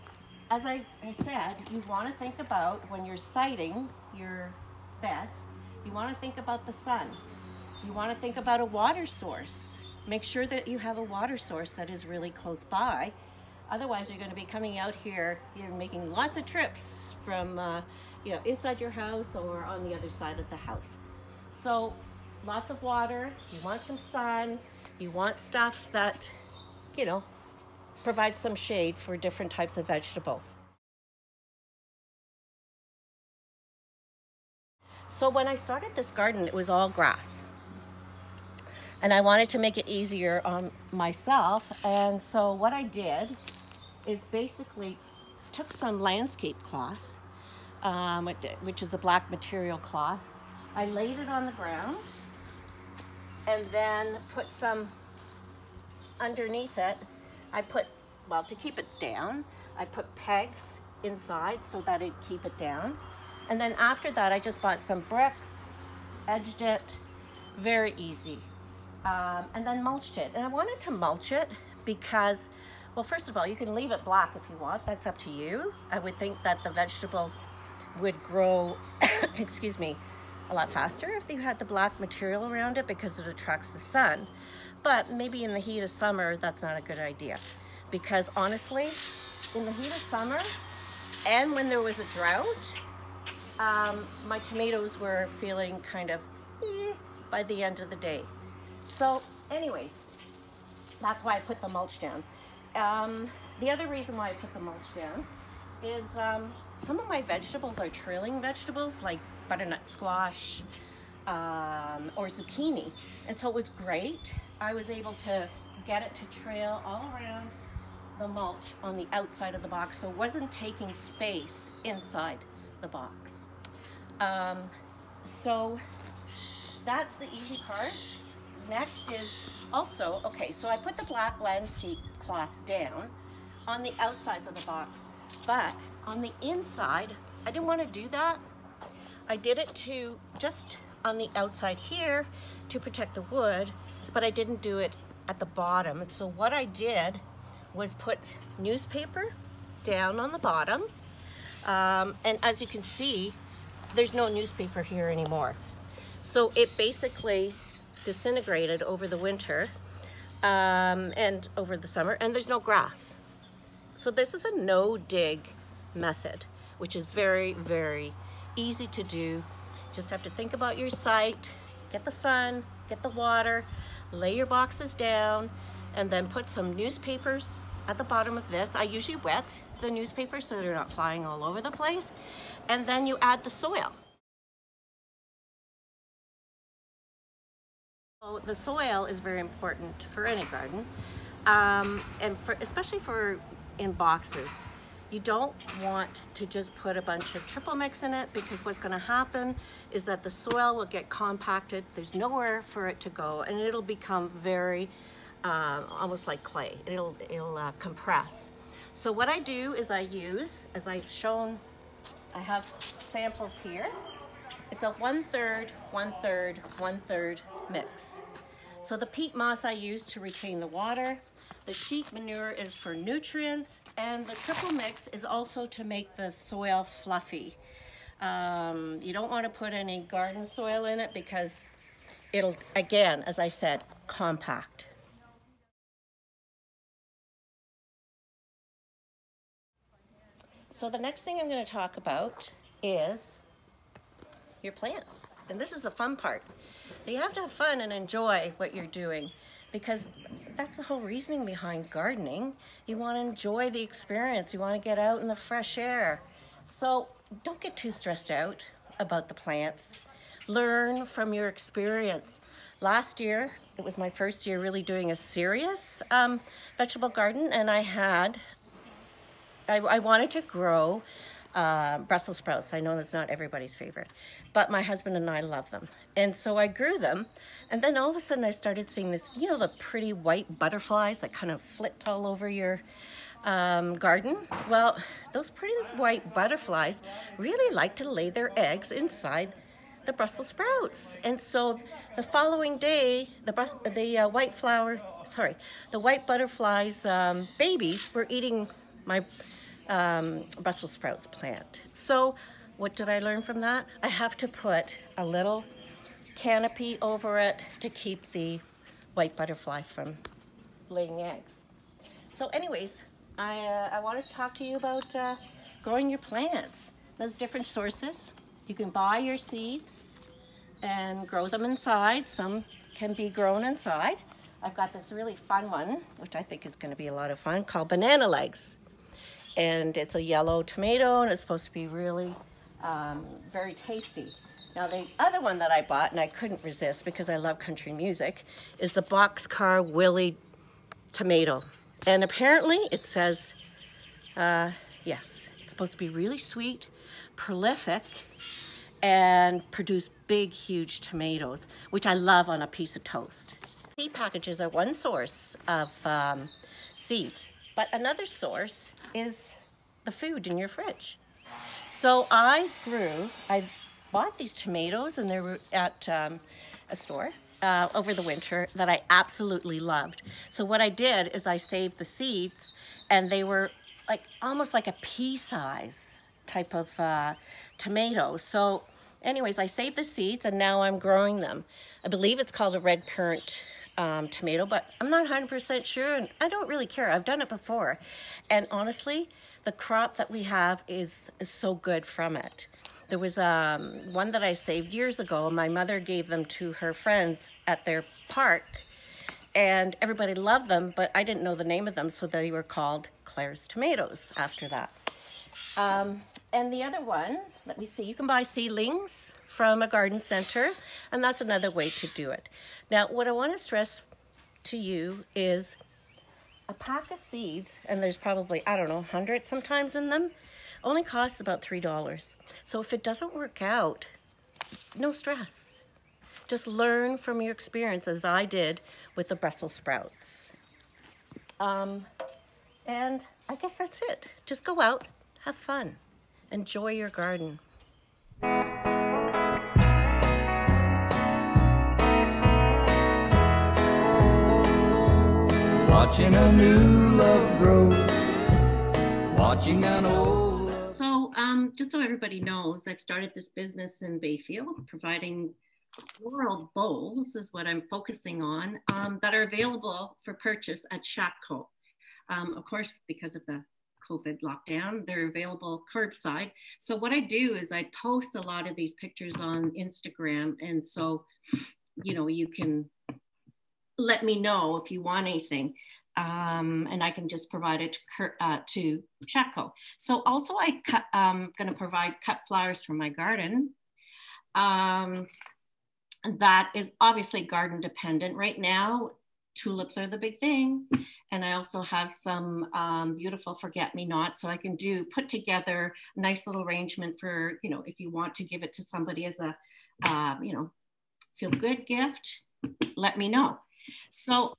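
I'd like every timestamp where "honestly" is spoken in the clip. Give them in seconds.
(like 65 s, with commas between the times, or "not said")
88 s, 388 s.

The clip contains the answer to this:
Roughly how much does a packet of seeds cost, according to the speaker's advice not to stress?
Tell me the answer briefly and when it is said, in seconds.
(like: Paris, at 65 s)
$3, at 421 s.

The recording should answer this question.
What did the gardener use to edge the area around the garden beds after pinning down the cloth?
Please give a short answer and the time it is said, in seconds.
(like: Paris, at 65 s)
bricks, at 65 s.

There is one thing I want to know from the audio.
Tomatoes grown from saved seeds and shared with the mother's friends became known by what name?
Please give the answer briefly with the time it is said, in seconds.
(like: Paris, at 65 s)
Claire's tomatoes, at 403 s.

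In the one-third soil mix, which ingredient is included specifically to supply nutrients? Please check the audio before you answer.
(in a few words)
sheep manure.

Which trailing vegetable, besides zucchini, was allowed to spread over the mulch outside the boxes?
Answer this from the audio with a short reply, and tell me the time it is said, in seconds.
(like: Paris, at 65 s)
butternut squash, at 109 s.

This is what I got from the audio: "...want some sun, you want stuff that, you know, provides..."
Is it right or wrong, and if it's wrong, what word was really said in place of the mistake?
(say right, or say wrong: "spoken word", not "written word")
right.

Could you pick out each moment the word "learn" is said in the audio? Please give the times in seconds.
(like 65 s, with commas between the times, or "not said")
260 s, 303 s, 426 s.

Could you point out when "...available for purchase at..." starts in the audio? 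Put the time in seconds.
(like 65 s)
459 s.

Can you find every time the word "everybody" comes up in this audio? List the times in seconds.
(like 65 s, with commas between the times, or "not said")
273 s, 399 s, 452 s.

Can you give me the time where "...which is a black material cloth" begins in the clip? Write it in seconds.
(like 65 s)
48 s.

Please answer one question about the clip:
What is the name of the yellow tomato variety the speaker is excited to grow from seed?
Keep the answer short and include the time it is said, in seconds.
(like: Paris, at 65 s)
banana legs, at 327 s.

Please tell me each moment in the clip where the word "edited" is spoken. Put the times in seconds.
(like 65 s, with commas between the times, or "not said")
not said.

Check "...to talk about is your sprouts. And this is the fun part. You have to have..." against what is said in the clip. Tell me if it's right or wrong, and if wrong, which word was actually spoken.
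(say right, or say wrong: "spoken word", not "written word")
wrong: "plants", not "sprouts".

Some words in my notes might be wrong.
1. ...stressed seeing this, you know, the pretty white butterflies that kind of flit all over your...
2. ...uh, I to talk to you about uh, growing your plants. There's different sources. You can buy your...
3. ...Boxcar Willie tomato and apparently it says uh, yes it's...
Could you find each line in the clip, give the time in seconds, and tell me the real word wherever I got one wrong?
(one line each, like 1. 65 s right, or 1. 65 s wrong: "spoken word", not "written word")
1. 278 s wrong: "started", not "stressed"
2. 313 s right
3. 339 s right.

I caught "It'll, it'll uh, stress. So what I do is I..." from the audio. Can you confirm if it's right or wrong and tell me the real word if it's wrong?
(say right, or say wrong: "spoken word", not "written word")
wrong: "compress", not "stress".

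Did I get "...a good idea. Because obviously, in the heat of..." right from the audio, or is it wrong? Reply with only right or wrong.
wrong.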